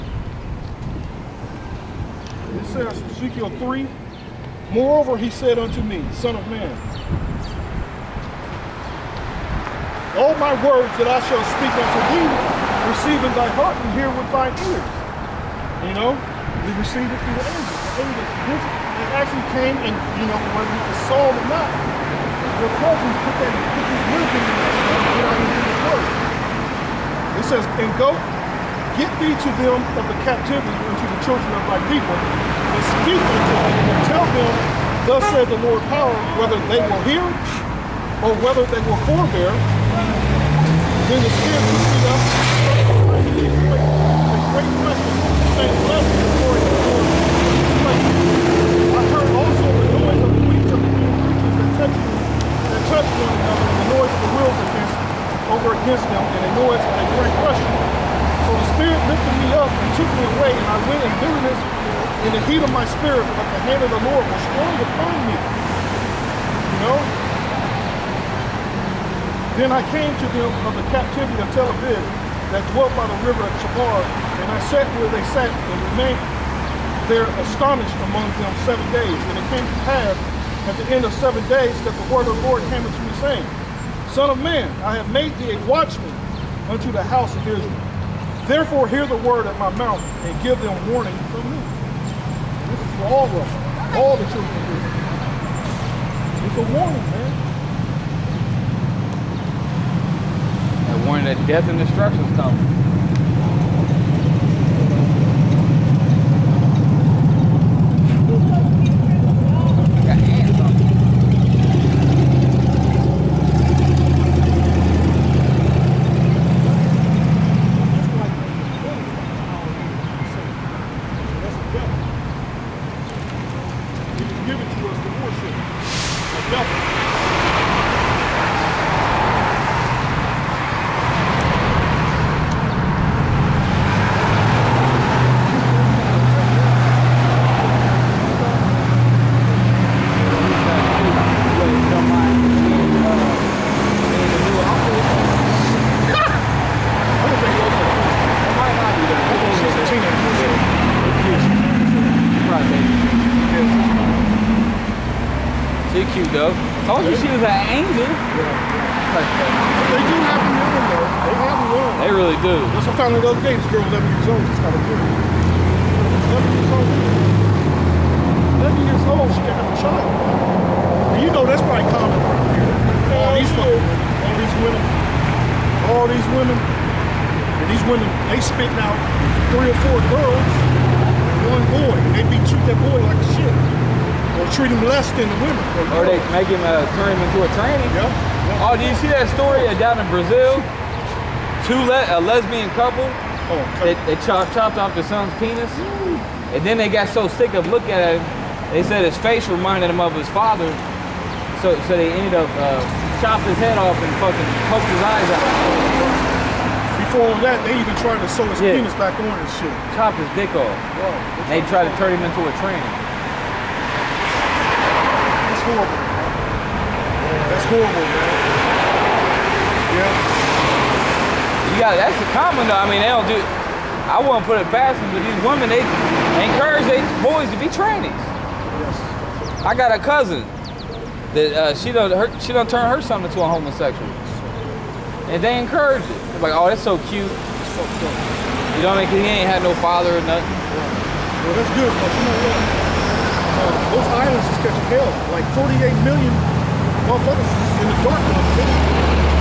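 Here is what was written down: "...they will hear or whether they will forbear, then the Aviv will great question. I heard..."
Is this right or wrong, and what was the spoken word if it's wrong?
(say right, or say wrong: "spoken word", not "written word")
wrong: "Spirit", not "Aviv".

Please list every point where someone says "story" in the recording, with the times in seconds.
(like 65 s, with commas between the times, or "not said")
189 s.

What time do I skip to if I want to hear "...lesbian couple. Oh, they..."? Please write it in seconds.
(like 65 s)
192 s.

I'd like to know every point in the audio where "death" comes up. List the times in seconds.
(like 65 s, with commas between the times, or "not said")
101 s.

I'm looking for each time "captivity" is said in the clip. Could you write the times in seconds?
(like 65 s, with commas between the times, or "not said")
30 s, 70 s.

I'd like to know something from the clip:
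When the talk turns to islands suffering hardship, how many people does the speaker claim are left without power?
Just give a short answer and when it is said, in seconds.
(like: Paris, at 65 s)
48 million, at 245 s.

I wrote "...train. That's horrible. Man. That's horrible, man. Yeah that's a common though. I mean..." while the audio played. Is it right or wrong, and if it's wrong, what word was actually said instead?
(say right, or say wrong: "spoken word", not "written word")
right.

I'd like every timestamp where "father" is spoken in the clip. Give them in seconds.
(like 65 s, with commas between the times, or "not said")
200 s, 239 s.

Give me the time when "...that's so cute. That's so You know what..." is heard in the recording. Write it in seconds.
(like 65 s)
236 s.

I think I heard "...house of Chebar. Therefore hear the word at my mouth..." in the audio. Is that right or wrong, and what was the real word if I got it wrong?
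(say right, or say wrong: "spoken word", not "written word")
wrong: "Israel", not "Chebar".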